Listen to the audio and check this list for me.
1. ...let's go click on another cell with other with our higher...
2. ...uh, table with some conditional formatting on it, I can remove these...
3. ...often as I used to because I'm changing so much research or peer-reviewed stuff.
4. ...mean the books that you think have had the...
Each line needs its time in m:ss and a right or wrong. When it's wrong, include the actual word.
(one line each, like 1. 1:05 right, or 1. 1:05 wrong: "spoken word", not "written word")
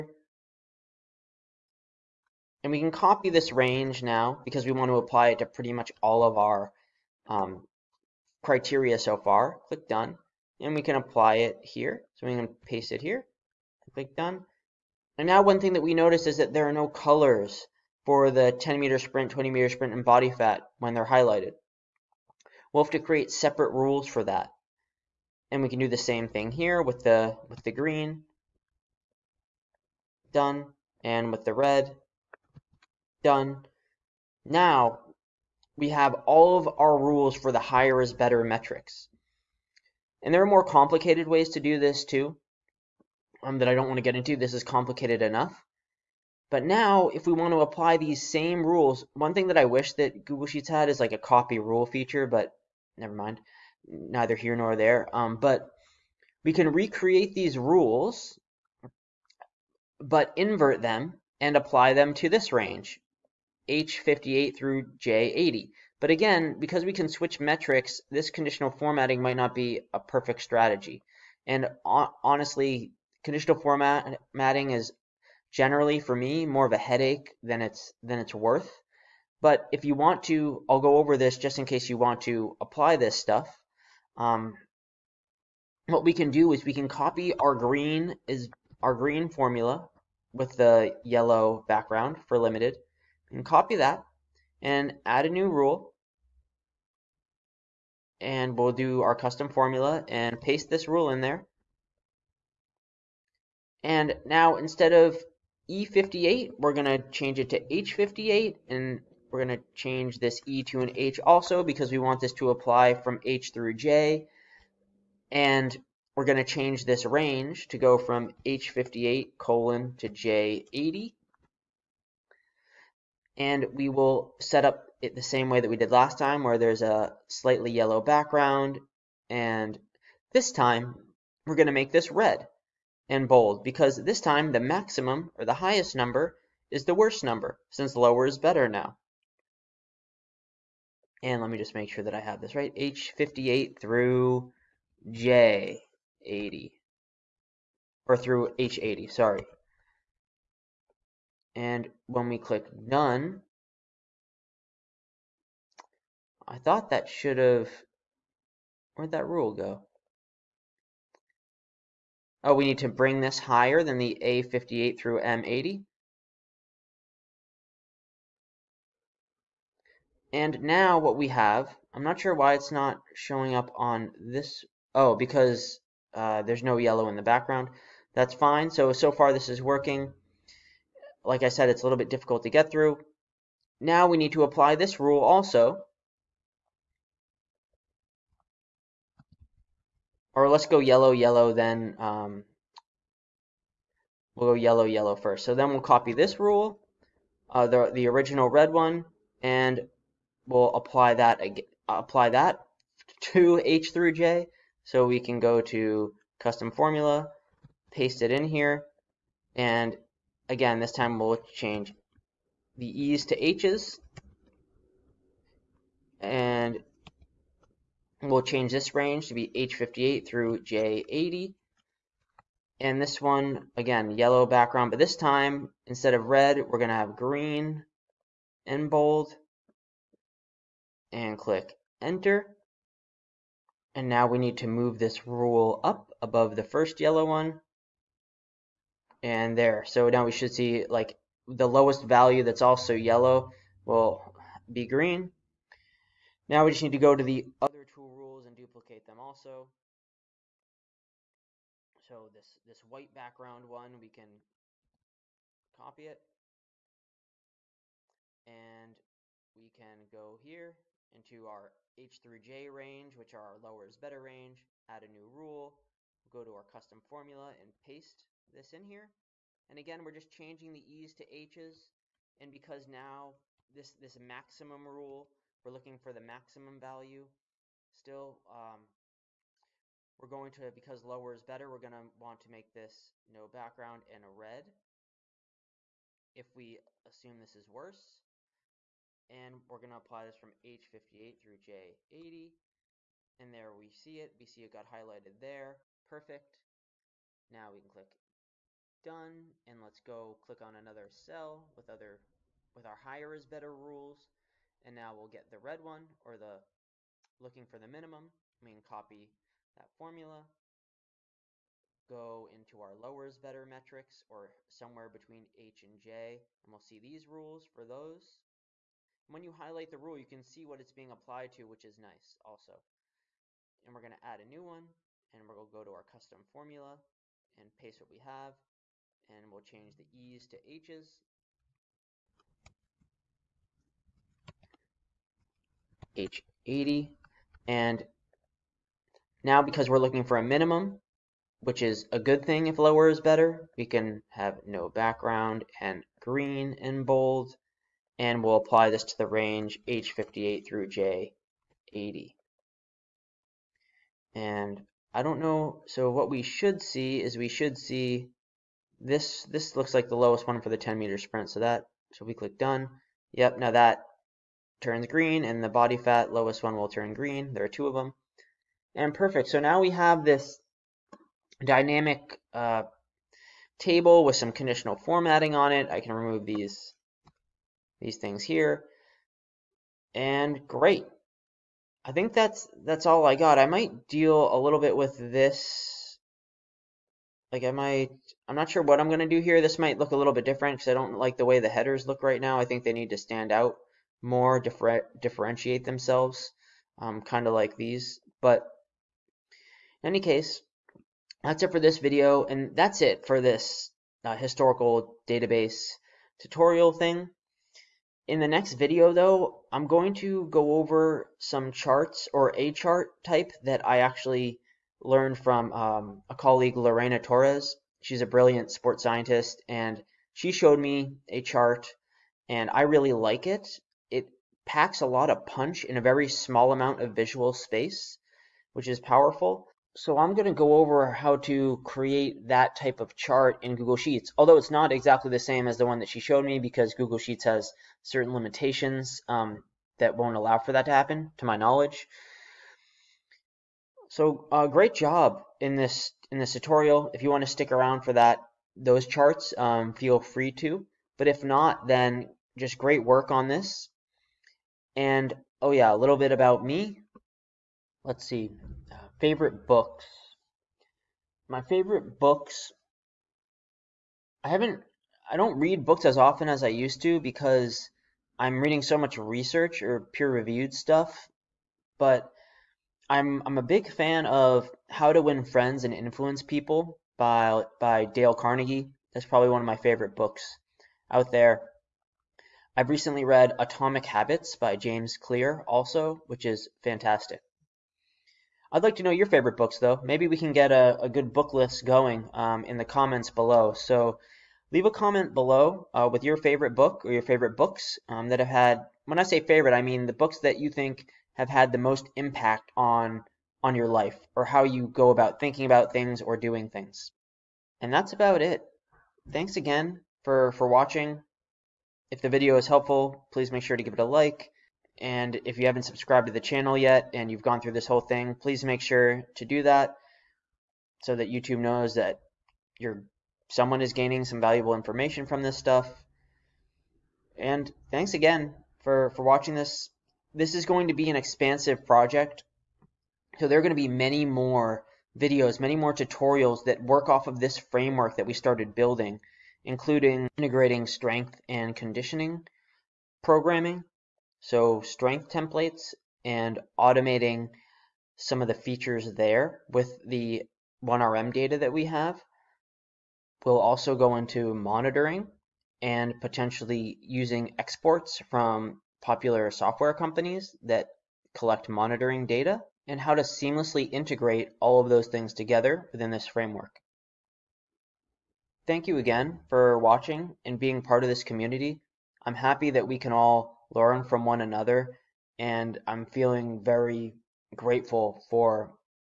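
1. 4:59 right
2. 6:12 right
3. 7:46 wrong: "reading", not "changing"
4. 8:19 right.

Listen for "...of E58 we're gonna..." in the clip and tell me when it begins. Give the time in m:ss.
1:44.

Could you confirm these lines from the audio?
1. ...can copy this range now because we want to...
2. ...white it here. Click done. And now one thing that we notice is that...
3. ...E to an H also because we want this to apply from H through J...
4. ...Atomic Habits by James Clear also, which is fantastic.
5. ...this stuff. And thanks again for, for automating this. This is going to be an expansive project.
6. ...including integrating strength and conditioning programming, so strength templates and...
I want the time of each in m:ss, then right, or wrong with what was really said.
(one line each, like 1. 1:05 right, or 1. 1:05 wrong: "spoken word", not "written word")
1. 0:02 right
2. 0:12 wrong: "paste", not "white"
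3. 1:50 right
4. 8:03 right
5. 8:45 wrong: "watching", not "automating"
6. 8:59 right.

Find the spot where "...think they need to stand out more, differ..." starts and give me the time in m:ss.
6:32.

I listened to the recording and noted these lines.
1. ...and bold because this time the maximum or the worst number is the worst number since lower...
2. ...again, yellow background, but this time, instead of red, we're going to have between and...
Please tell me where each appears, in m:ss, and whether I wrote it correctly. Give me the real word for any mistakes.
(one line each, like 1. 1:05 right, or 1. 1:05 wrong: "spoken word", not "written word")
1. 2:13 wrong: "highest", not "worst"
2. 3:43 wrong: "green", not "between".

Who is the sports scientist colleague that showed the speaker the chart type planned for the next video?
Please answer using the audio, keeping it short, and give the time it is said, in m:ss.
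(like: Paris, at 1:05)
Lorena Torres, at 6:56.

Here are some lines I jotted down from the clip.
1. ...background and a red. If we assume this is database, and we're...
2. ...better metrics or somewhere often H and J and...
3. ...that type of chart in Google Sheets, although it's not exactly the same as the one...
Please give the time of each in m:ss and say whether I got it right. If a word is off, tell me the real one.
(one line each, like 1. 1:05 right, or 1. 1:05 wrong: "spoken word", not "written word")
1. 4:43 wrong: "worse", not "database"
2. 5:13 wrong: "between", not "often"
3. 7:12 right.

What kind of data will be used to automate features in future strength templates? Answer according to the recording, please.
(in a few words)
1RM data.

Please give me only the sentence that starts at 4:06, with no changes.
Now we just need to go to the other two rules and duplicate them also.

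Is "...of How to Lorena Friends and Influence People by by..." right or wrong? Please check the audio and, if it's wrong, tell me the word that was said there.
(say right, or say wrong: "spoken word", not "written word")
wrong: "Win", not "Lorena".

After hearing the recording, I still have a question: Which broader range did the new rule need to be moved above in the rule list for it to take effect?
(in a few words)
A58 through M80.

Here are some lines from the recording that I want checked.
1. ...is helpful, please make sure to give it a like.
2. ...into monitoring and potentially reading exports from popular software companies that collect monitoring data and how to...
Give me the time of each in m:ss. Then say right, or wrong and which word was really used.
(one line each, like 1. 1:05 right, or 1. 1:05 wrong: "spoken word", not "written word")
1. 8:32 right
2. 9:14 wrong: "using", not "reading".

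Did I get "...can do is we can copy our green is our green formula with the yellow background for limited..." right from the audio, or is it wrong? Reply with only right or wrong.
right.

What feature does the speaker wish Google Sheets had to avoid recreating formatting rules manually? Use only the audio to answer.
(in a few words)
Copy rule feature.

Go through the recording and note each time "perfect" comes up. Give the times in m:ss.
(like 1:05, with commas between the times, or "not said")
1:09, 4:56, 6:09.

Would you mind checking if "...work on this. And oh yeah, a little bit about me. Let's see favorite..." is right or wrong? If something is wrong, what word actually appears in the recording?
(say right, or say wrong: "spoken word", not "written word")
right.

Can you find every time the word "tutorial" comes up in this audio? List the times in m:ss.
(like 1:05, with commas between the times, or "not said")
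6:46, 7:26, 8:55.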